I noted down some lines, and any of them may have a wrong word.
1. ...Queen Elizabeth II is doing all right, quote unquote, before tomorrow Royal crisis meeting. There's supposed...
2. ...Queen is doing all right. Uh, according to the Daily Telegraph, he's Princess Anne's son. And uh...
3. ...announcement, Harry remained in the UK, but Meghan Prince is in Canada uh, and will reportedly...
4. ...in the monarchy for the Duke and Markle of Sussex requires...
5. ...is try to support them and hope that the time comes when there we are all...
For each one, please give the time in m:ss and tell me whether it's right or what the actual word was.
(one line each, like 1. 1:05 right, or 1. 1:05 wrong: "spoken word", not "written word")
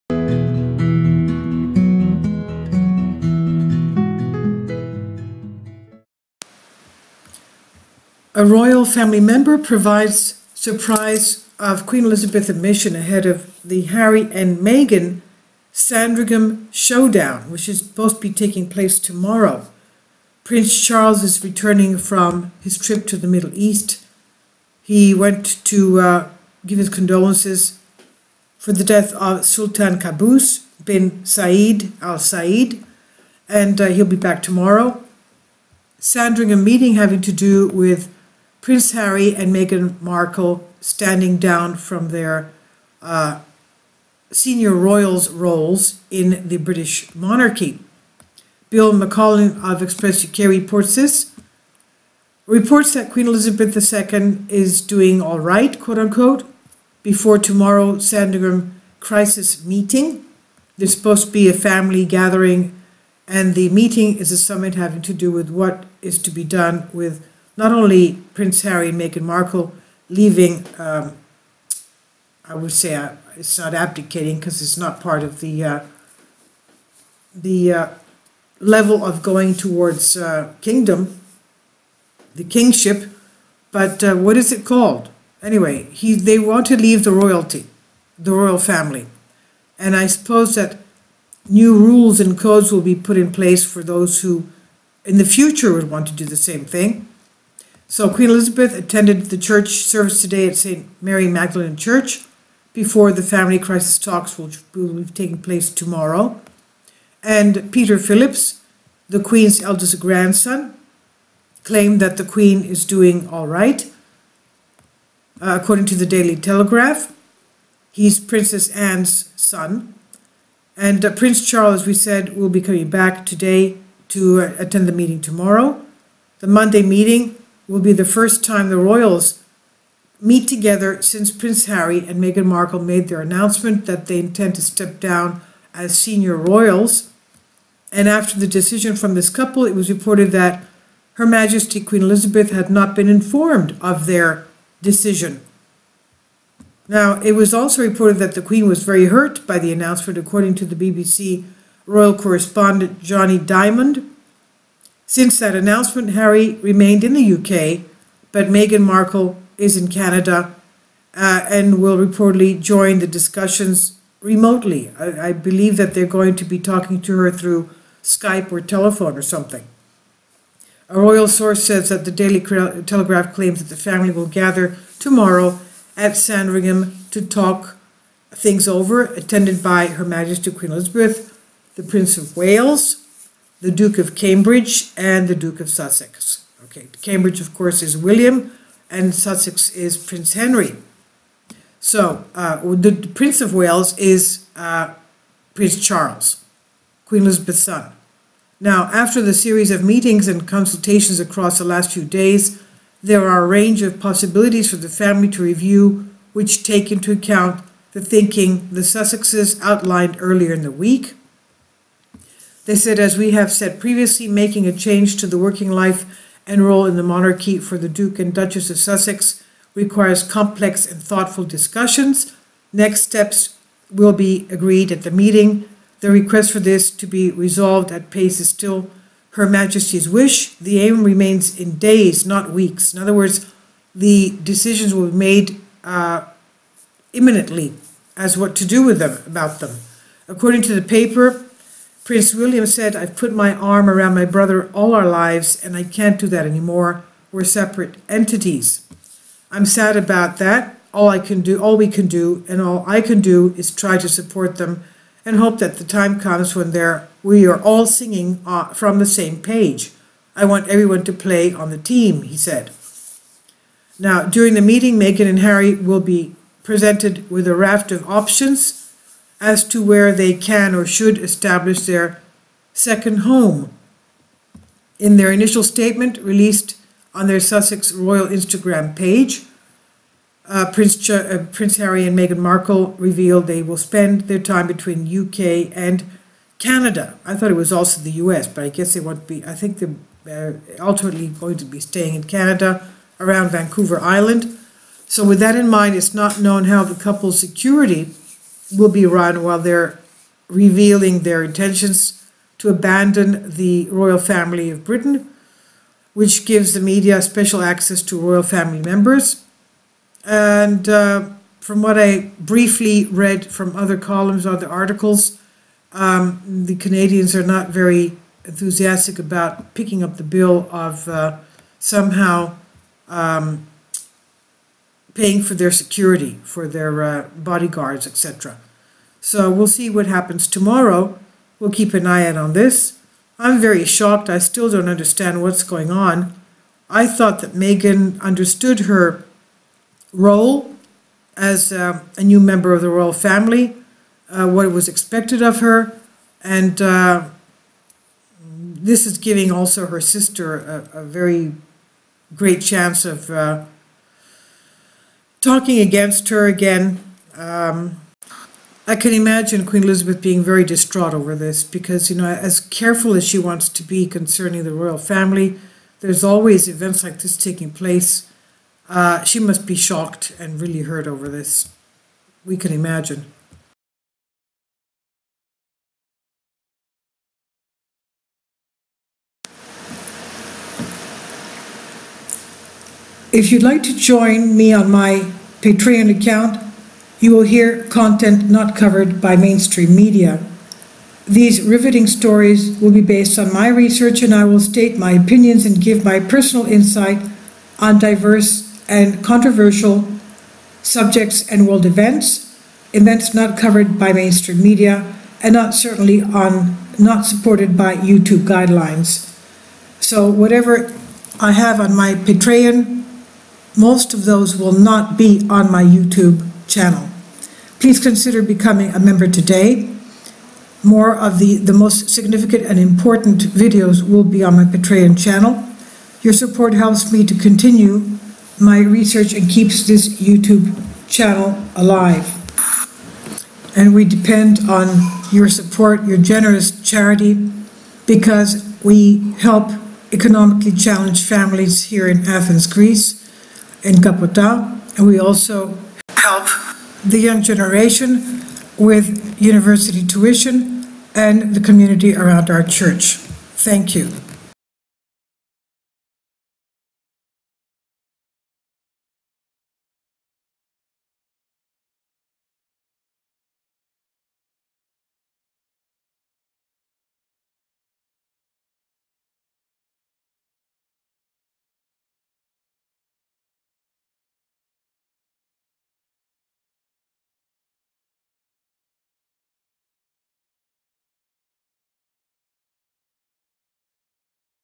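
1. 0:53 wrong: "Sandringham", not "Royal"
2. 1:52 right
3. 2:35 wrong: "Markle", not "Prince"
4. 3:36 wrong: "Duchess", not "Markle"
5. 4:13 right.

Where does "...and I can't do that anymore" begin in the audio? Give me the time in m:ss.
4:05.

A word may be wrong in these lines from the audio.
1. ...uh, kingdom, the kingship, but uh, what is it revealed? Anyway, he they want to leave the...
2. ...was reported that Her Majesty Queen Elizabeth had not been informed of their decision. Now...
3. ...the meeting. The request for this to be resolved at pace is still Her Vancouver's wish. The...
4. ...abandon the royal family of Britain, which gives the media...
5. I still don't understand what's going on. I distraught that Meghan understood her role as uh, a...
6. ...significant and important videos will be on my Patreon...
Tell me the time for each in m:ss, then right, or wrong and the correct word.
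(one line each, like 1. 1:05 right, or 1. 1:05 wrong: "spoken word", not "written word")
1. 1:20 wrong: "called", not "revealed"
2. 2:19 right
3. 3:45 wrong: "Majesty", not "Vancouver"
4. 5:02 right
5. 5:34 wrong: "thought", not "distraught"
6. 7:02 right.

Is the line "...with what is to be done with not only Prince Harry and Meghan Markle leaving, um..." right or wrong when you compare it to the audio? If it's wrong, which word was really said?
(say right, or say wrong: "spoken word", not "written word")
right.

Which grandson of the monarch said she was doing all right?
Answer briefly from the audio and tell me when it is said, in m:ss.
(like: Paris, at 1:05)
Peter Phillips, at 1:47.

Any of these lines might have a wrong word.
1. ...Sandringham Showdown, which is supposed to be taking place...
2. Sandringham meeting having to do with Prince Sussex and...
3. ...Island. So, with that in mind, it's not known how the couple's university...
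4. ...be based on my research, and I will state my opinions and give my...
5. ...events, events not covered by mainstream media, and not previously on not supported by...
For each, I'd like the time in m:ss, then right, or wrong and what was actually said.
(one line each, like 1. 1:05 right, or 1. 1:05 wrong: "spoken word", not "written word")
1. 0:15 right
2. 0:35 wrong: "Harry", not "Sussex"
3. 4:53 wrong: "security", not "university"
4. 6:32 right
5. 6:41 wrong: "certainly", not "previously".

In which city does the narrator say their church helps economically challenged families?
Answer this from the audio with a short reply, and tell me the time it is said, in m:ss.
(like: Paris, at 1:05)
Athens, Greece, at 7:22.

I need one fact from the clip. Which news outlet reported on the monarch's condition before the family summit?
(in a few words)
Express UK.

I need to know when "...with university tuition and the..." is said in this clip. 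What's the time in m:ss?
7:28.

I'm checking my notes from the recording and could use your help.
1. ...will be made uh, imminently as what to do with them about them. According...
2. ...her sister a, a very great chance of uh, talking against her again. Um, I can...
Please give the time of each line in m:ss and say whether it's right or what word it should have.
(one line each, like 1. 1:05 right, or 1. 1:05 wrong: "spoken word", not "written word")
1. 3:54 right
2. 5:49 right.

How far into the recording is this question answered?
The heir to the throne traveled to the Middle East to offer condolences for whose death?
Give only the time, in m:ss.
0:29.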